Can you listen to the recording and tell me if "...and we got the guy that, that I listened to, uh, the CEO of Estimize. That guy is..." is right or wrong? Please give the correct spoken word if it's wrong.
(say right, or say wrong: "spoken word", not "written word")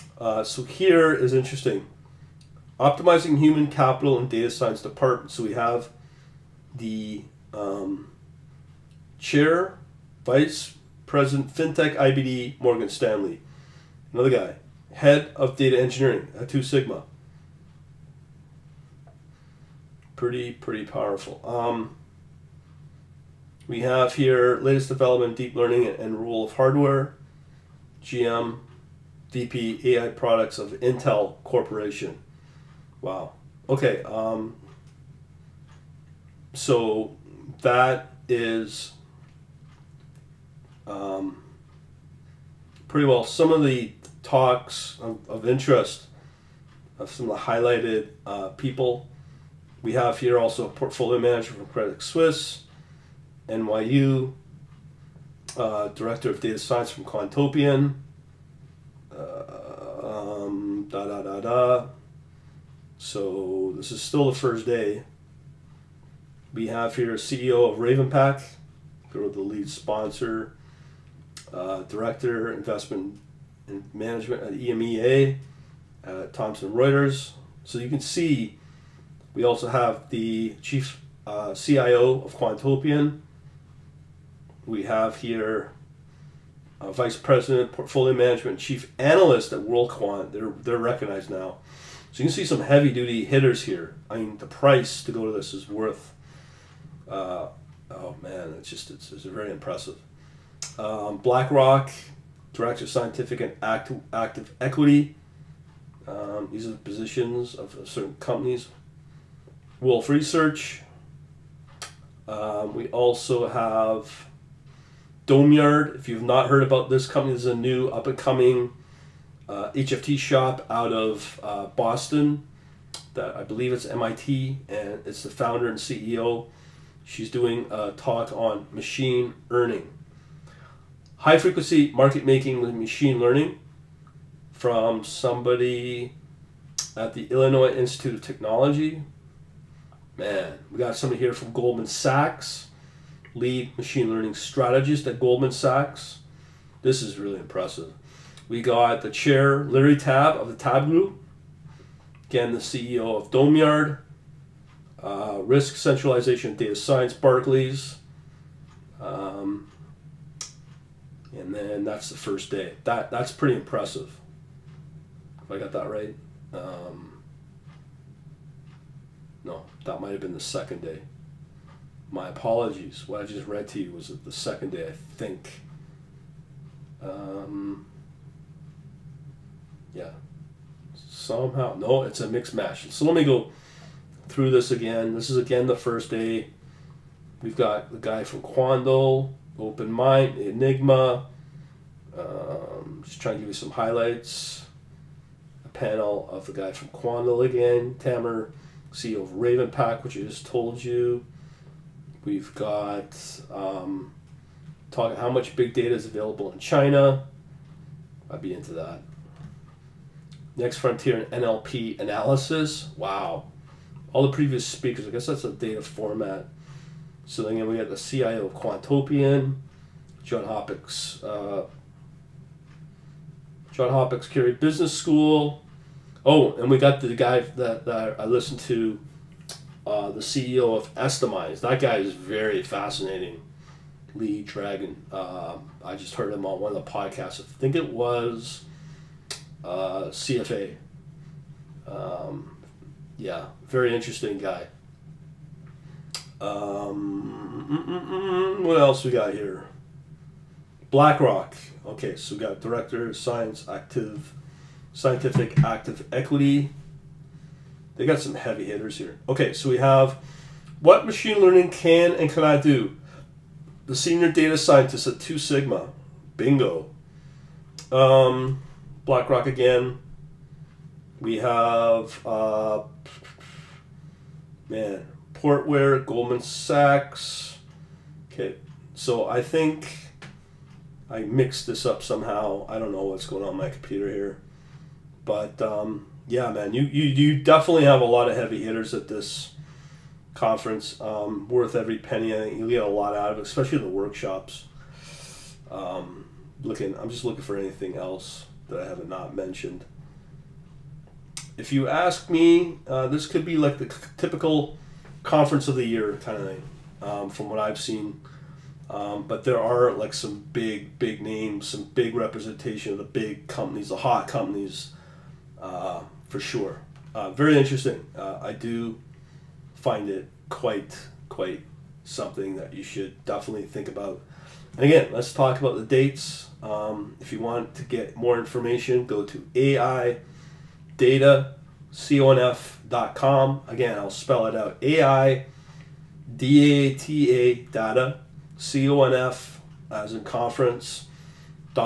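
right.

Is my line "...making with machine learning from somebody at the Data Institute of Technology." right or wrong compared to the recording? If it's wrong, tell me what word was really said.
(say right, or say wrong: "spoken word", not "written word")
wrong: "Illinois", not "Data".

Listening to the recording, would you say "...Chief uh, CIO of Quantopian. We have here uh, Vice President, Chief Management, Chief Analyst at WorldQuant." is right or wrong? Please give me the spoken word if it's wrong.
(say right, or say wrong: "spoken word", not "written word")
wrong: "Portfolio", not "Chief".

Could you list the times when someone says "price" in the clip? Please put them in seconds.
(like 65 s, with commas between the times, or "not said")
94 s.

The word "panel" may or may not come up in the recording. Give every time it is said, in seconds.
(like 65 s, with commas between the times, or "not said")
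195 s.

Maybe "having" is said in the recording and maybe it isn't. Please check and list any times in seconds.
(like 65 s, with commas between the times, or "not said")
not said.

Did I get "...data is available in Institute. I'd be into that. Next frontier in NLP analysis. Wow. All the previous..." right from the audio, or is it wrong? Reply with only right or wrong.
wrong.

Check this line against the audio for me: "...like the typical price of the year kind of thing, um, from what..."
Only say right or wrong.
wrong.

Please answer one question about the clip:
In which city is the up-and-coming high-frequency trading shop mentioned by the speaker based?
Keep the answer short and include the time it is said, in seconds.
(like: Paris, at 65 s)
Boston, at 121 s.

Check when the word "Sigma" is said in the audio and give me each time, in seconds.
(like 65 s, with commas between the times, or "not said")
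16 s, 265 s.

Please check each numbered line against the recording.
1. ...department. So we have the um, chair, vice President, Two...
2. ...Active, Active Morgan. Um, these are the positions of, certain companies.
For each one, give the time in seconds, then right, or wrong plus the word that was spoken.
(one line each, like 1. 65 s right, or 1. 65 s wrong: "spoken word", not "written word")
1. 4 s wrong: "FinTech", not "Two"
2. 103 s wrong: "Equity", not "Morgan".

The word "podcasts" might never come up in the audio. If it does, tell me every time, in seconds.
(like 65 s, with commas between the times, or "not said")
236 s.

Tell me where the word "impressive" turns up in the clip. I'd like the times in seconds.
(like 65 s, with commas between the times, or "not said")
99 s, 147 s, 163 s.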